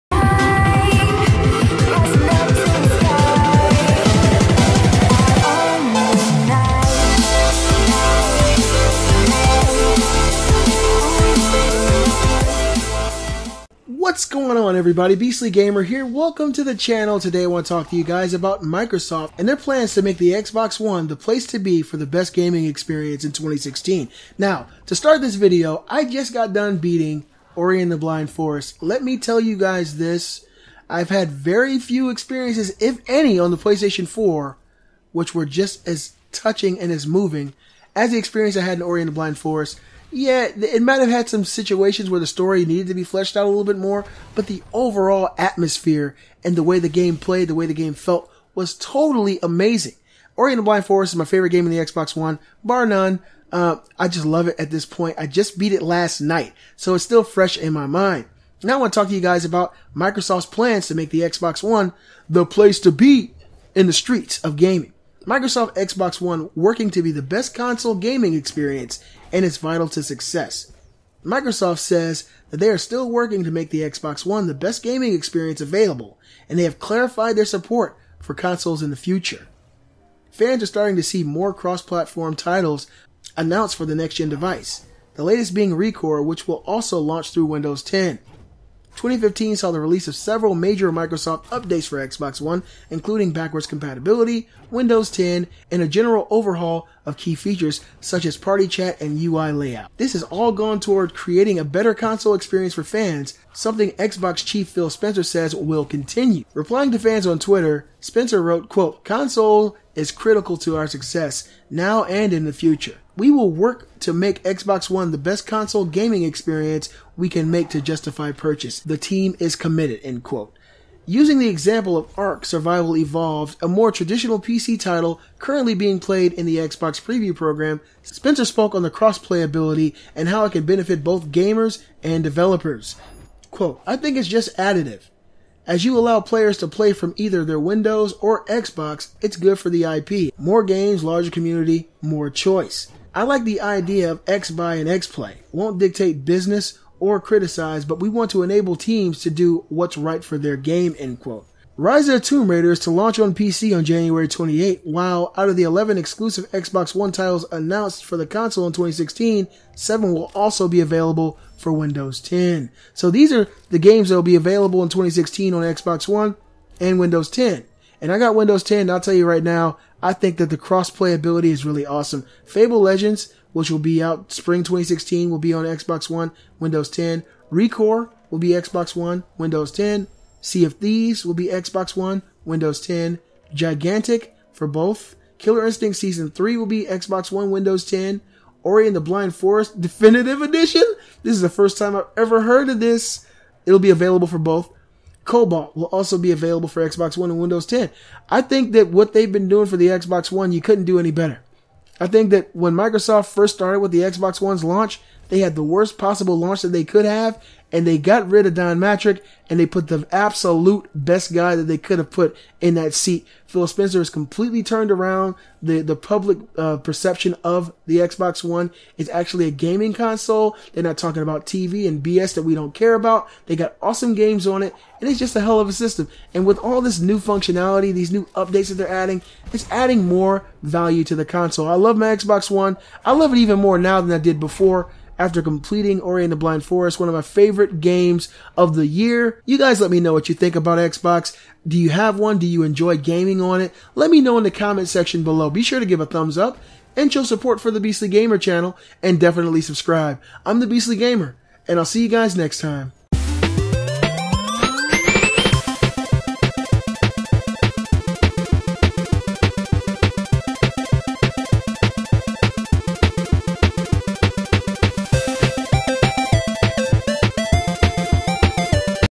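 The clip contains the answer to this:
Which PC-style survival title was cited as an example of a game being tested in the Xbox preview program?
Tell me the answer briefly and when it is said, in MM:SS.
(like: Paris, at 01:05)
Ark Survival Evolved, at 02:02.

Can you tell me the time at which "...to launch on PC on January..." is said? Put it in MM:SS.
02:32.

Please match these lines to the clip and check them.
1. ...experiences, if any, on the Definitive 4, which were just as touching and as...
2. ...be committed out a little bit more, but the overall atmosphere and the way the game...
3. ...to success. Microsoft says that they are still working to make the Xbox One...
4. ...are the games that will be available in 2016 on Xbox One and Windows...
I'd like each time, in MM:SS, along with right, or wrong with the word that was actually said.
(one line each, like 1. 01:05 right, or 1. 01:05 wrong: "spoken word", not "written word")
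1. 00:32 wrong: "PlayStation", not "Definitive"
2. 00:42 wrong: "fleshed", not "committed"
3. 01:09 right
4. 02:43 right.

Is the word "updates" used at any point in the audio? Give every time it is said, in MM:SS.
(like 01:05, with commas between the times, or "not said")
01:31, 03:48.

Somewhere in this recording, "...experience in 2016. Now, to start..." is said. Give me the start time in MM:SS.
00:22.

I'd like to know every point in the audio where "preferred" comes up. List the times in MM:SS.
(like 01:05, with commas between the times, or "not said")
not said.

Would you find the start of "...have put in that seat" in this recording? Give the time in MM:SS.
03:31.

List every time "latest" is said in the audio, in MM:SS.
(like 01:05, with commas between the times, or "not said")
01:25.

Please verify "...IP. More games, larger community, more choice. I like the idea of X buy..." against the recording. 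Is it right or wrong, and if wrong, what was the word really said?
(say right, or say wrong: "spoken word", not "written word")
right.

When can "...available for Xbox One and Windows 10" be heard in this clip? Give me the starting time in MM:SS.
03:16.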